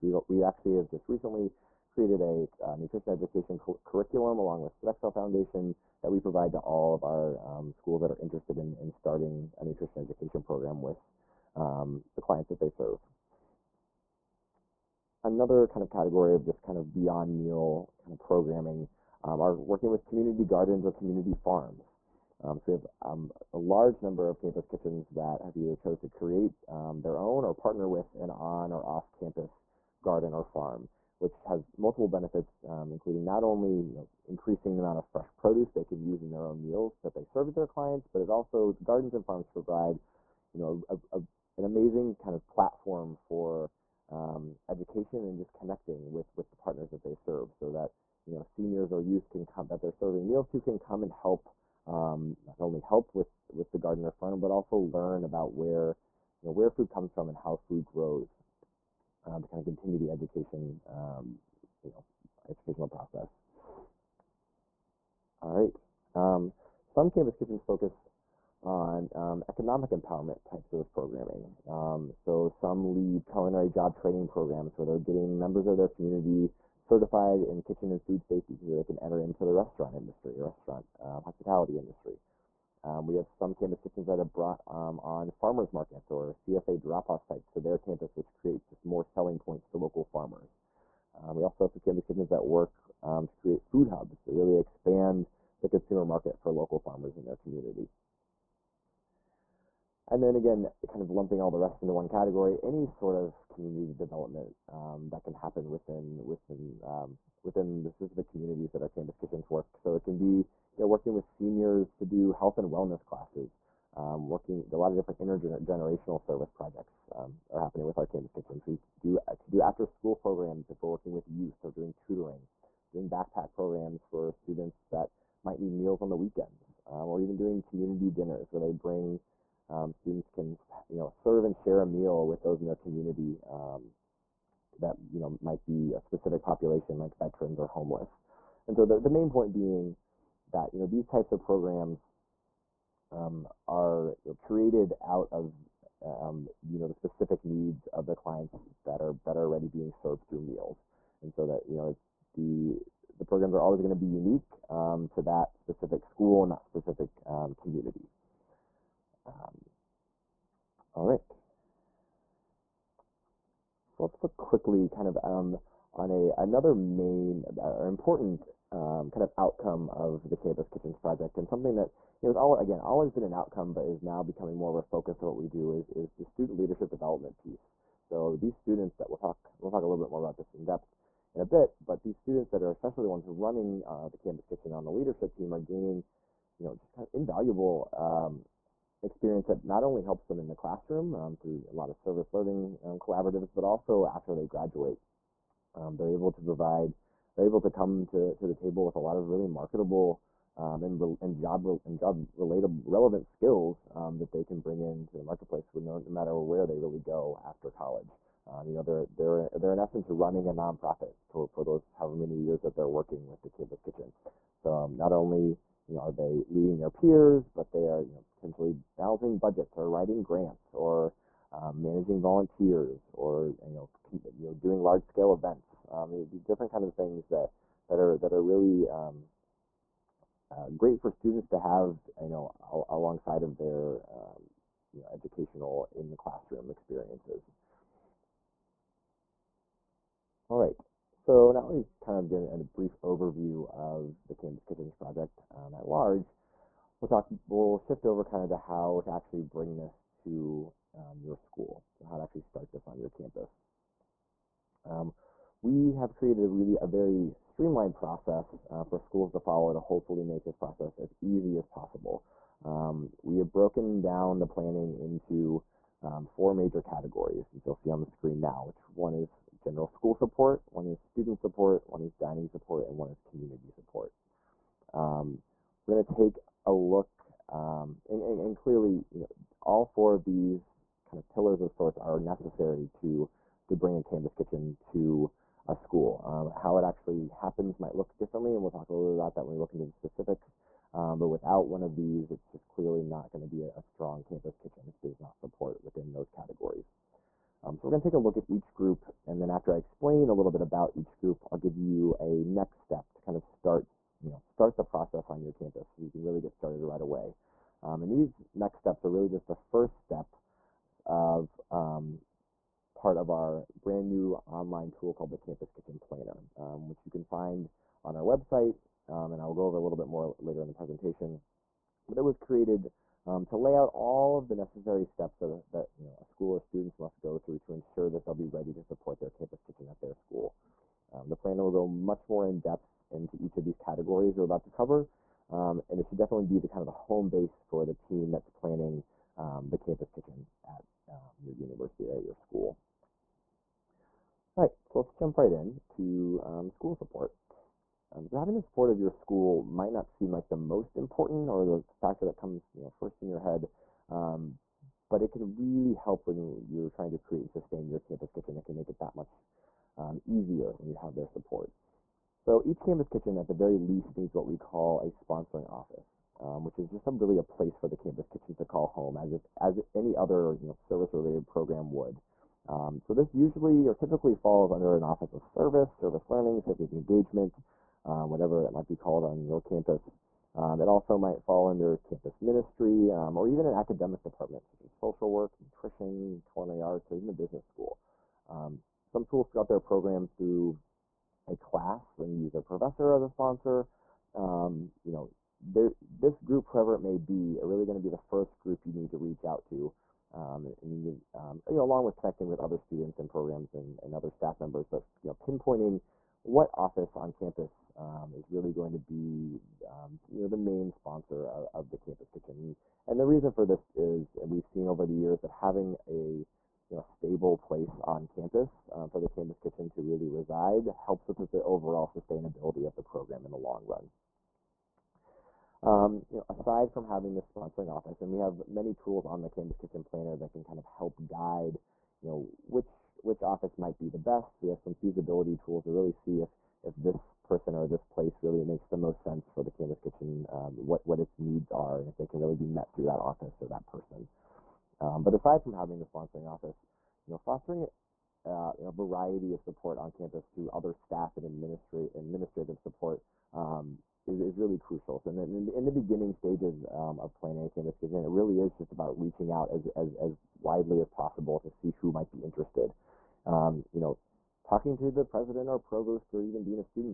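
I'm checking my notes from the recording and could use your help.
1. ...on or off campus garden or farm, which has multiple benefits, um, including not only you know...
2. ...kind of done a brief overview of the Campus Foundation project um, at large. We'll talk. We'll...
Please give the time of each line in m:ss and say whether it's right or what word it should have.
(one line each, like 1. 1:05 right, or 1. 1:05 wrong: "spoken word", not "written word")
1. 0:28 right
2. 4:02 wrong: "Kitchens", not "Foundation".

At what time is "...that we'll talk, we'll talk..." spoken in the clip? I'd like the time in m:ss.
2:58.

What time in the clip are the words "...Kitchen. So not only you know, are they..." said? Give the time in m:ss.
3:33.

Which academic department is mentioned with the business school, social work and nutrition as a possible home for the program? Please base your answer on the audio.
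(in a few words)
culinary arts.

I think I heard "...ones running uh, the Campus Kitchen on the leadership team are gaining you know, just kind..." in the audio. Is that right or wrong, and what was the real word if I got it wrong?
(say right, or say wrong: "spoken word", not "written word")
right.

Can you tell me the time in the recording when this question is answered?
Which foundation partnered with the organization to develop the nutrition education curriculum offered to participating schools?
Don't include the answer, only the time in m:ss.
0:04.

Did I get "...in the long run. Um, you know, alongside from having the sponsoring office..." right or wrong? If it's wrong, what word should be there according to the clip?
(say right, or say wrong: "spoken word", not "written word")
wrong: "aside", not "alongside".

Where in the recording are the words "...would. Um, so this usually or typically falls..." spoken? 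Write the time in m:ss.
6:11.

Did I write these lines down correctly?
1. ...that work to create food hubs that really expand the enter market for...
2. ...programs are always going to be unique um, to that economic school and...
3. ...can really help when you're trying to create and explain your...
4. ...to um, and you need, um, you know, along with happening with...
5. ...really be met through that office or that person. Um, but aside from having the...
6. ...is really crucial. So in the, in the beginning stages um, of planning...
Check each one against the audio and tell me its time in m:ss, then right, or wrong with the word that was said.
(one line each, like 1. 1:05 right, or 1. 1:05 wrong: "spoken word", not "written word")
1. 1:32 wrong: "consumer", not "enter"
2. 2:33 wrong: "specific", not "economic"
3. 5:55 wrong: "sustain", not "explain"
4. 6:39 wrong: "connecting", not "happening"
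5. 7:22 right
6. 7:34 right.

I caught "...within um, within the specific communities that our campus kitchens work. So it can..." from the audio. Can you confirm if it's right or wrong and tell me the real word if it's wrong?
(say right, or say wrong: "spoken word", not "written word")
right.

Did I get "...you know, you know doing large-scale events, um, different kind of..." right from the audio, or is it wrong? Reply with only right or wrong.
right.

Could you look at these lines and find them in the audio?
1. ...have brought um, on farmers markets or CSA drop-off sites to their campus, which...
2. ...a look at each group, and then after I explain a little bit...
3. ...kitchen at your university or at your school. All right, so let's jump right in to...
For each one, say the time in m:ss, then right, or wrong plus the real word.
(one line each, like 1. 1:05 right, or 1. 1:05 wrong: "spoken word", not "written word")
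1. 1:24 right
2. 4:58 right
3. 5:40 right.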